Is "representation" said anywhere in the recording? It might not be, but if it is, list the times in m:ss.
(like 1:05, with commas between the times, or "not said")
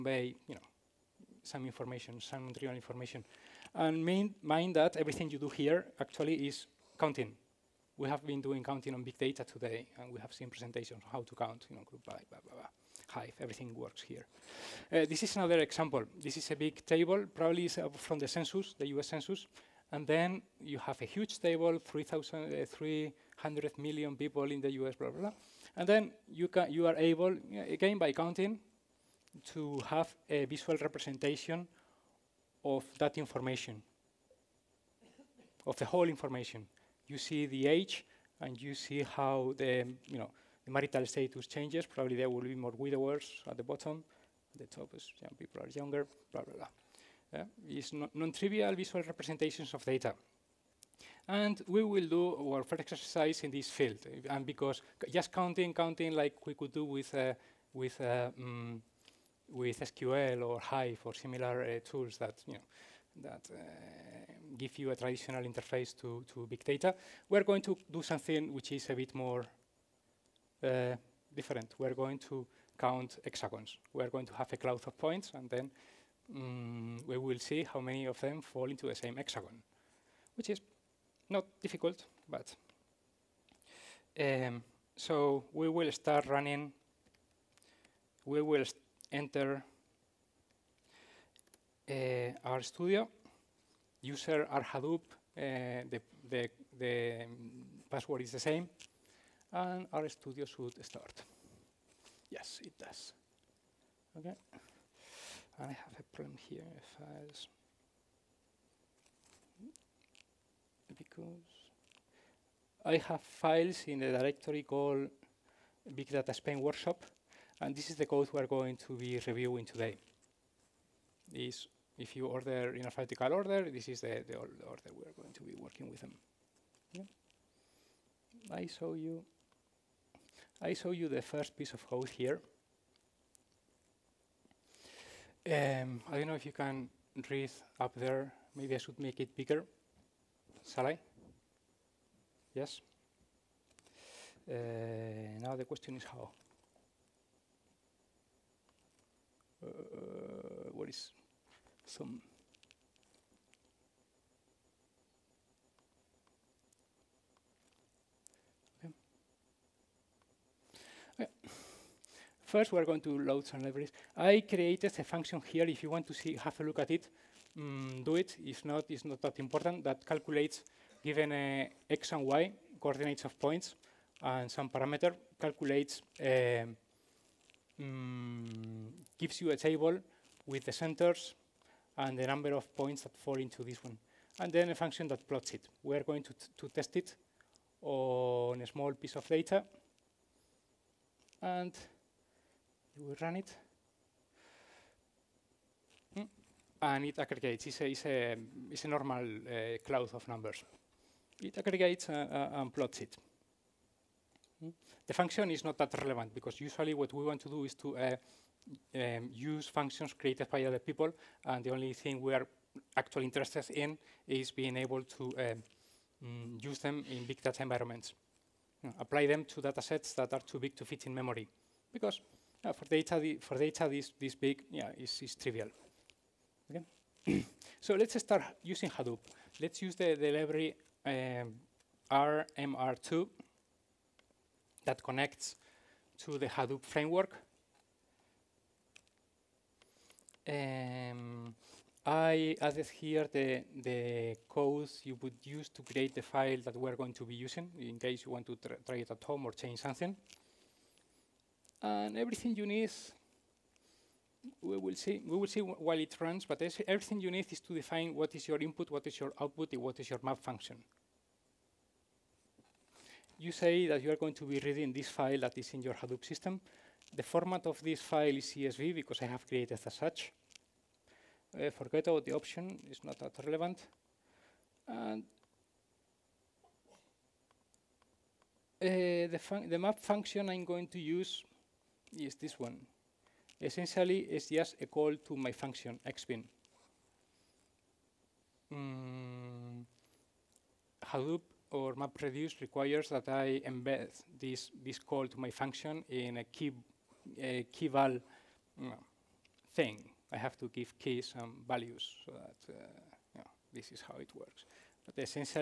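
0:30, 0:49.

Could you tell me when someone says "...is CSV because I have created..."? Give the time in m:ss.
4:28.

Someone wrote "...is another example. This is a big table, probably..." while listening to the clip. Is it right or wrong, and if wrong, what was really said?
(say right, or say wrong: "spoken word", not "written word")
right.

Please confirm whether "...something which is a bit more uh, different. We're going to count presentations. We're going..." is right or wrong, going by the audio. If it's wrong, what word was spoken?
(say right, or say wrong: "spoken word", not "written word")
wrong: "hexagons", not "presentations".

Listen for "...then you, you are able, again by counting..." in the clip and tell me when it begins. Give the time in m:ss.
0:25.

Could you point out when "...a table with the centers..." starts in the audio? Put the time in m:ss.
2:59.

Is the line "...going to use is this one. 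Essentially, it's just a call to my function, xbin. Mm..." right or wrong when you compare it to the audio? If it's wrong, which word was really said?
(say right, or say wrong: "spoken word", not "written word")
right.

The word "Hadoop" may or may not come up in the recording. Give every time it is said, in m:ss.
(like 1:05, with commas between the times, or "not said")
1:34, 3:48, 3:56, 4:25, 4:51.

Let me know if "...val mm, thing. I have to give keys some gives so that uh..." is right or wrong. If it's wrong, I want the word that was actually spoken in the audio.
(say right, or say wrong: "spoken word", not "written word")
wrong: "values", not "gives".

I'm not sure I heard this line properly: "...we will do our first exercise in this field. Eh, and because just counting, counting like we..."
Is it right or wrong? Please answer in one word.
right.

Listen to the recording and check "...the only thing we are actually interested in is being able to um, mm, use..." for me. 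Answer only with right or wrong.
right.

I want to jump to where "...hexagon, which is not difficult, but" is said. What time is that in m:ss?
1:19.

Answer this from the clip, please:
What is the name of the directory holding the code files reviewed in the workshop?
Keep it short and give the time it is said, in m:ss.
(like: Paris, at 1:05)
Big Data Spain Workshop, at 1:55.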